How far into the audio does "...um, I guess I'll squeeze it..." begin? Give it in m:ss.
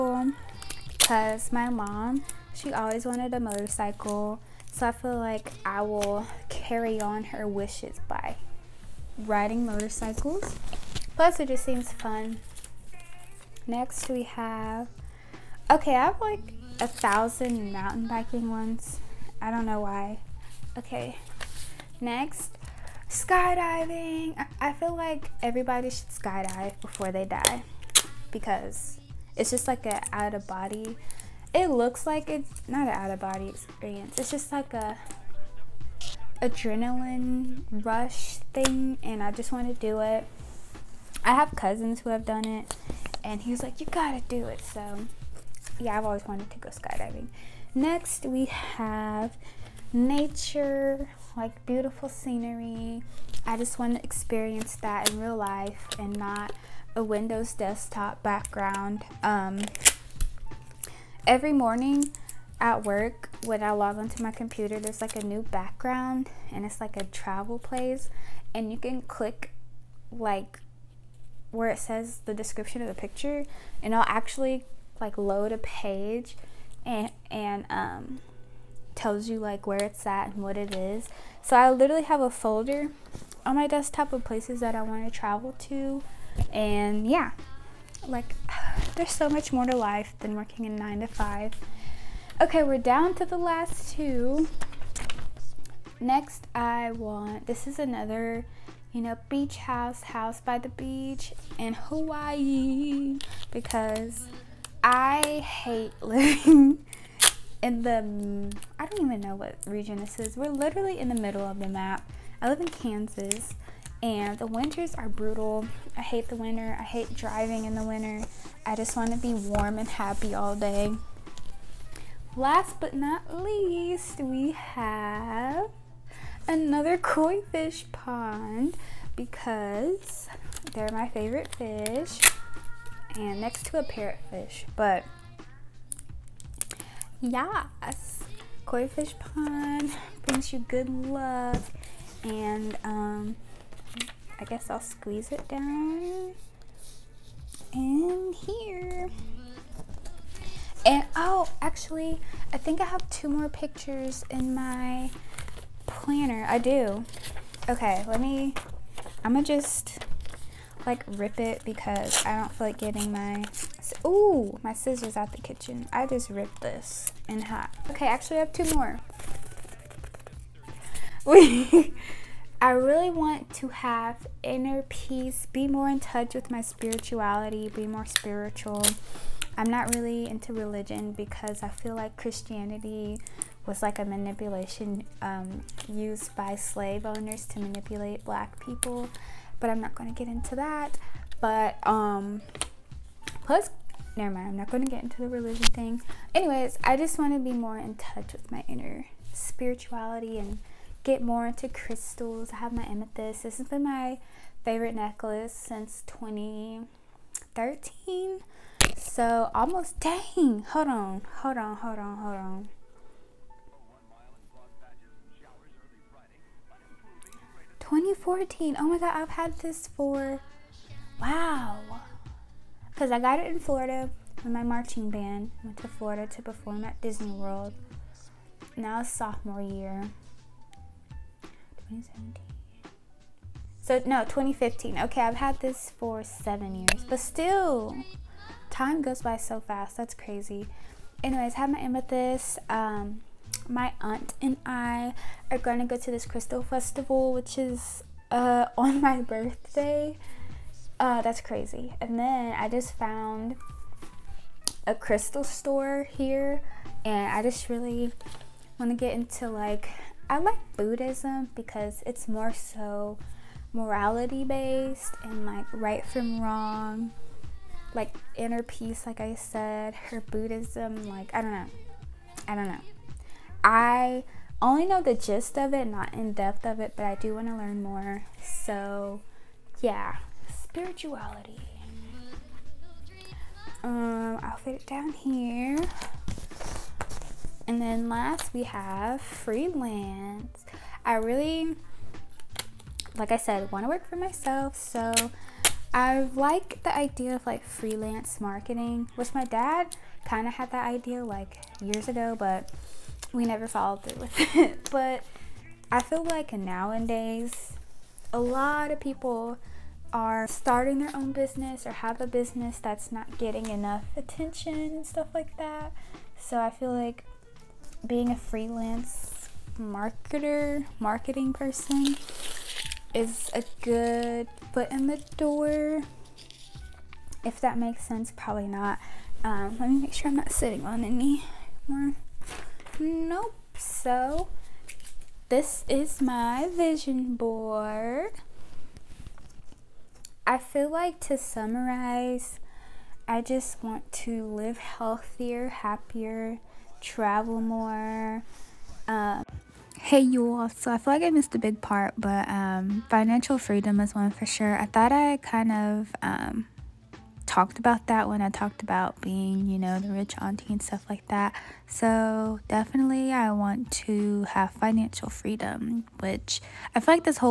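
2:22.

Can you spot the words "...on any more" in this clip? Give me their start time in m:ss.
5:30.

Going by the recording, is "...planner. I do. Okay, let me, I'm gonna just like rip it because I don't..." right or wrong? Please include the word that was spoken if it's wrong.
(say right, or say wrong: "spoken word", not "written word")
right.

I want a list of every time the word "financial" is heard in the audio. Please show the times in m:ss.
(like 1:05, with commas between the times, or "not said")
5:53, 6:04.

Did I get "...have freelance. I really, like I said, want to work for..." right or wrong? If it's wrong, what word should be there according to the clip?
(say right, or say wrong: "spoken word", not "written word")
right.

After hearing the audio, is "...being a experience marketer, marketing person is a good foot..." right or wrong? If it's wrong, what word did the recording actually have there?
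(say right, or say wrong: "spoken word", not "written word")
wrong: "freelance", not "experience".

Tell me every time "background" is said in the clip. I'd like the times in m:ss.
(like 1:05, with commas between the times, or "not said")
0:58, 1:05.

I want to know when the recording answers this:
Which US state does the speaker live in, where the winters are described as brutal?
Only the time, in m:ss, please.
1:52.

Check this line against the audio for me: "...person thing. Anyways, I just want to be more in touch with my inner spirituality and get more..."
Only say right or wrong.
wrong.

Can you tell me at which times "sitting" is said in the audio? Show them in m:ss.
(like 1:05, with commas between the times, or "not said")
5:30.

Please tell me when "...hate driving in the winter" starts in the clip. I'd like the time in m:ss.
1:56.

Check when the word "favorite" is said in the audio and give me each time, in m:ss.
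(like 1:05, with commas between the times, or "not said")
2:11, 3:24.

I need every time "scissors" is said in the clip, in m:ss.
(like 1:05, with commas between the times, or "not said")
2:44.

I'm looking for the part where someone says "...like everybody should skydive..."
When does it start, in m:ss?
0:24.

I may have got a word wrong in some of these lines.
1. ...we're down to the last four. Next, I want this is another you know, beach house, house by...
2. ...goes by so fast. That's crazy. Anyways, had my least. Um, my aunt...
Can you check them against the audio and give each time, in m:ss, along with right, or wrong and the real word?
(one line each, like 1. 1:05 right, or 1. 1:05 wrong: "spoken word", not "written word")
1. 1:32 wrong: "two", not "four"
2. 3:59 wrong: "amethyst", not "least".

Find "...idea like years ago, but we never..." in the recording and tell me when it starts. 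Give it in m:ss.
5:00.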